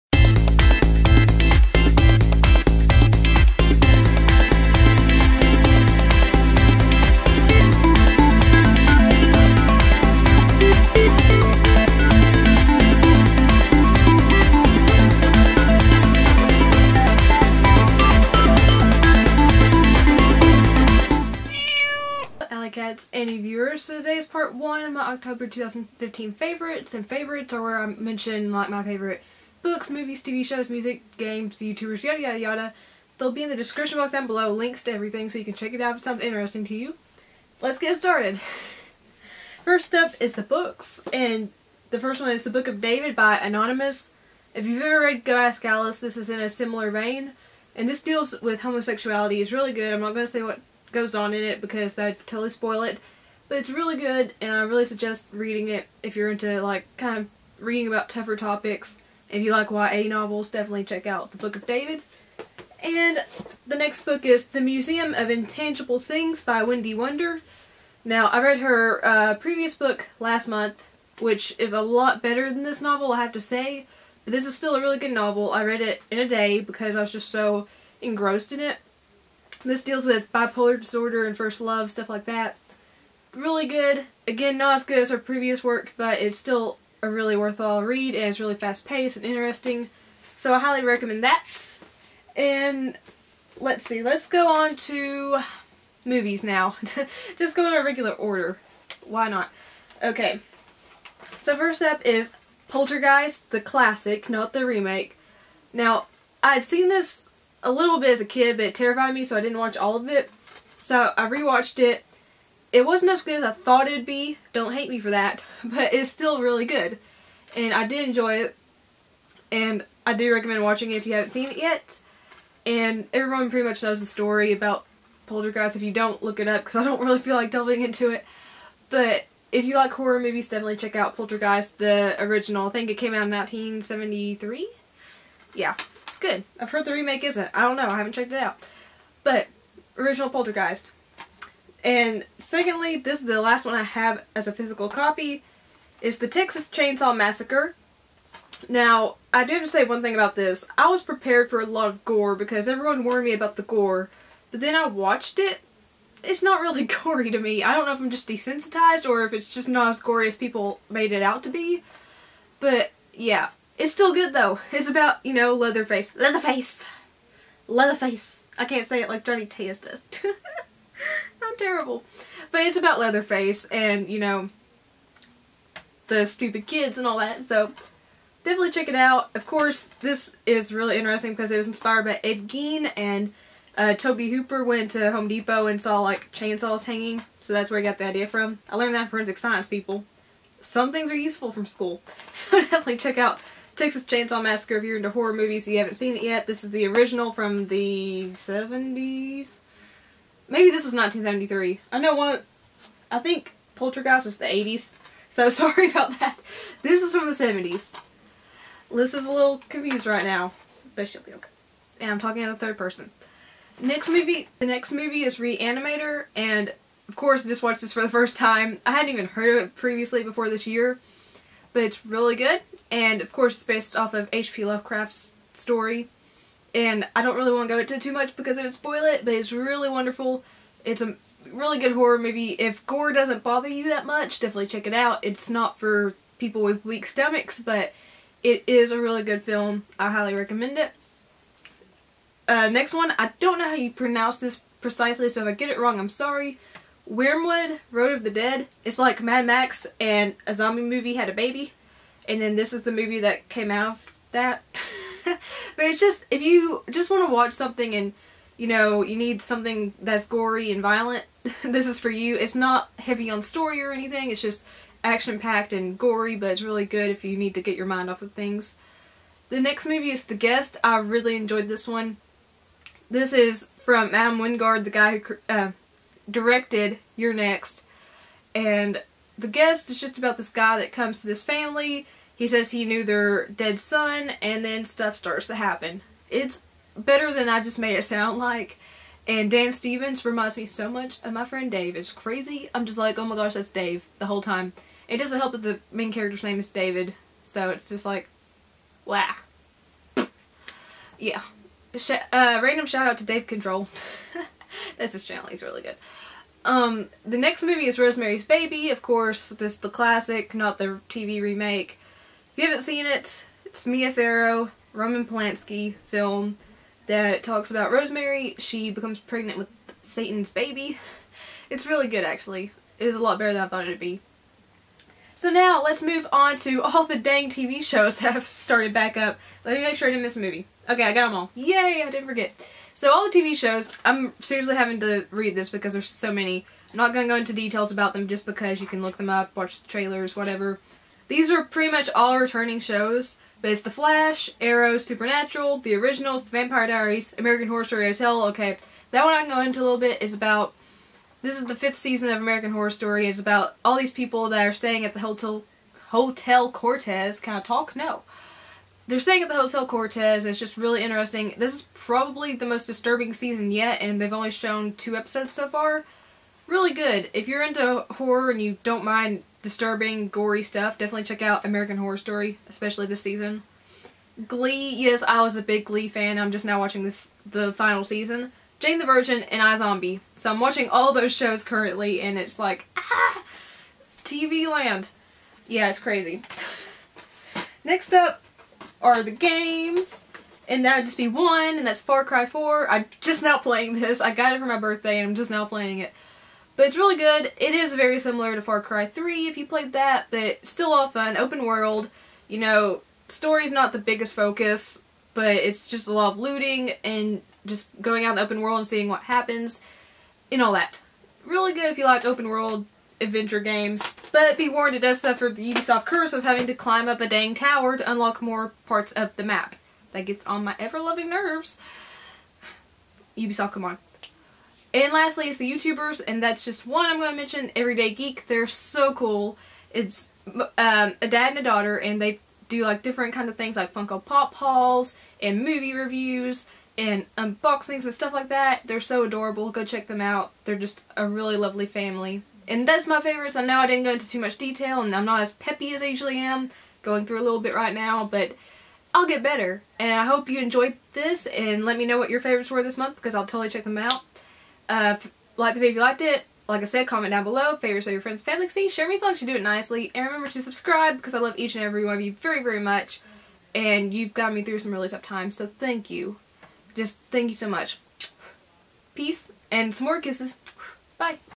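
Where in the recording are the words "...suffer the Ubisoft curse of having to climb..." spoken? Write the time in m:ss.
6:55.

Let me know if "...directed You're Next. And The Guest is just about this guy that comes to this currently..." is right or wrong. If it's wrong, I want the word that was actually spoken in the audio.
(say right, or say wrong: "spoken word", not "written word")
wrong: "family", not "currently".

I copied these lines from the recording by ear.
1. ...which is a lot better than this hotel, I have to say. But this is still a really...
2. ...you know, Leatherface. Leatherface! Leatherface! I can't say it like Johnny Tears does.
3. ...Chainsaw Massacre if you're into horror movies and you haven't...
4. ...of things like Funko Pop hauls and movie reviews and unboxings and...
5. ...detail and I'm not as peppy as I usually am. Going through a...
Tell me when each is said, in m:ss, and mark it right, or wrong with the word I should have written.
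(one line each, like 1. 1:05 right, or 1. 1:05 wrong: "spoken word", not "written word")
1. 1:11 wrong: "novel", not "hotel"
2. 2:45 right
3. 3:14 right
4. 7:13 right
5. 7:24 right.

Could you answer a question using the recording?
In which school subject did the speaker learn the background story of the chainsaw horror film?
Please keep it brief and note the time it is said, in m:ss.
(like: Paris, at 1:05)
forensic science, at 3:09.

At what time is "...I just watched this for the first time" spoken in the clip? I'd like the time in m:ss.
3:37.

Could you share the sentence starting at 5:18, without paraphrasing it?
She becomes pregnant with Satan's baby.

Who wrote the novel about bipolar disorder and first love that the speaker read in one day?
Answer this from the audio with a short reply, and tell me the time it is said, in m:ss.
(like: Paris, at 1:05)
Wendy Wunder, at 1:06.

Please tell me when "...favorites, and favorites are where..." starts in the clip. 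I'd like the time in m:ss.
0:26.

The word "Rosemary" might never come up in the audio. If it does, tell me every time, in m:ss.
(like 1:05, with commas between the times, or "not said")
5:07, 5:17.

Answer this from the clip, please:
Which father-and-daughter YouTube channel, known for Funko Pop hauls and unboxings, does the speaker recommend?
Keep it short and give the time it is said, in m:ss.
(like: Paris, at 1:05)
Everyday Geek, at 7:07.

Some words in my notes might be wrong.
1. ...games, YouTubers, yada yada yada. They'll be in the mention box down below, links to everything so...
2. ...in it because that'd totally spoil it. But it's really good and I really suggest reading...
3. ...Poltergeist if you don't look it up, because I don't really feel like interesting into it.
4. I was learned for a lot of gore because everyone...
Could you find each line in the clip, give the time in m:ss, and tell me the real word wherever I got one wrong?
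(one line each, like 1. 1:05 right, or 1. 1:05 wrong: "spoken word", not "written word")
1. 0:31 wrong: "description", not "mention"
2. 0:51 right
3. 2:05 wrong: "delving", not "interesting"
4. 2:30 wrong: "prepared", not "learned".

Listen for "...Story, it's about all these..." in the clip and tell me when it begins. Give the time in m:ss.
5:52.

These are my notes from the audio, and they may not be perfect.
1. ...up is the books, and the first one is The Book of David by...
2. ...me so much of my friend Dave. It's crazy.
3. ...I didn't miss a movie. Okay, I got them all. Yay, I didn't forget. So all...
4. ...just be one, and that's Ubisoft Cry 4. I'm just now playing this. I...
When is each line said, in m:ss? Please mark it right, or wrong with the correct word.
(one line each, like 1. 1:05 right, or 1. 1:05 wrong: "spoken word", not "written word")
1. 0:39 right
2. 4:50 right
3. 5:30 right
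4. 6:31 wrong: "Far", not "Ubisoft".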